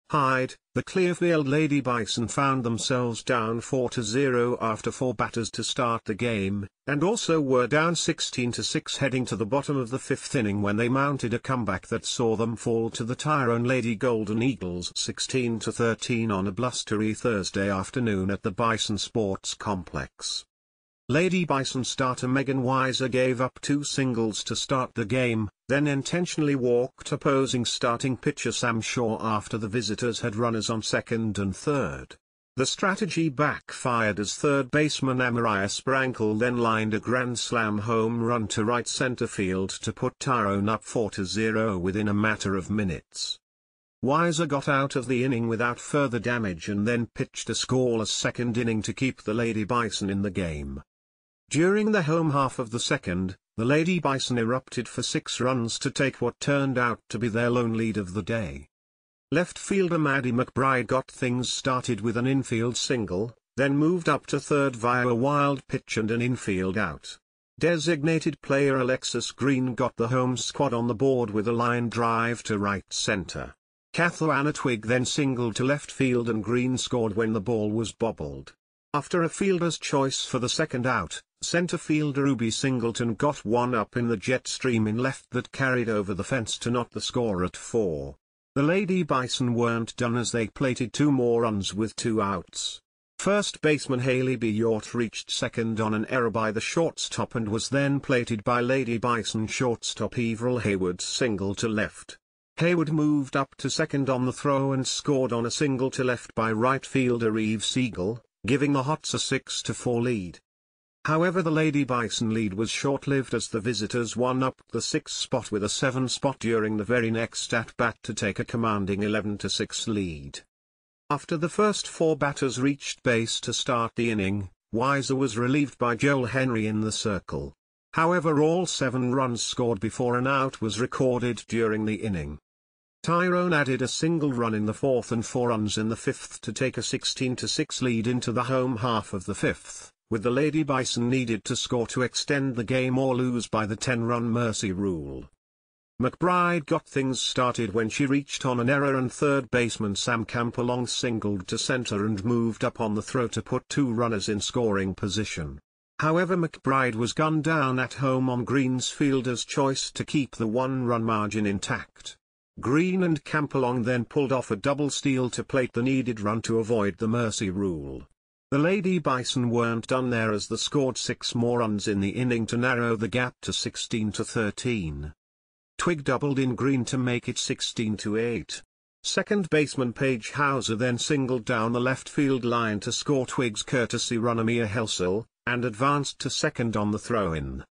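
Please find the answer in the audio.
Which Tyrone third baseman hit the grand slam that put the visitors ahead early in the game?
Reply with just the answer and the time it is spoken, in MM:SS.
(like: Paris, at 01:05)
Amariah Sprankle, at 00:35.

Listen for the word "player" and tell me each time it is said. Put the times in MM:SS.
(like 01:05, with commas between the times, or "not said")
01:08.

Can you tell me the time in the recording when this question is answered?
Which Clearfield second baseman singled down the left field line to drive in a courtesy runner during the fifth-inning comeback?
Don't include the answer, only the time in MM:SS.
02:59.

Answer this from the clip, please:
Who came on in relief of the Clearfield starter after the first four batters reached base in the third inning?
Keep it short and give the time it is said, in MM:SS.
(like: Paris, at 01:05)
Joel Henry, at 02:05.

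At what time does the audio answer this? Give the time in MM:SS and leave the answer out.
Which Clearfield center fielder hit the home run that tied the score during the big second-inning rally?
01:22.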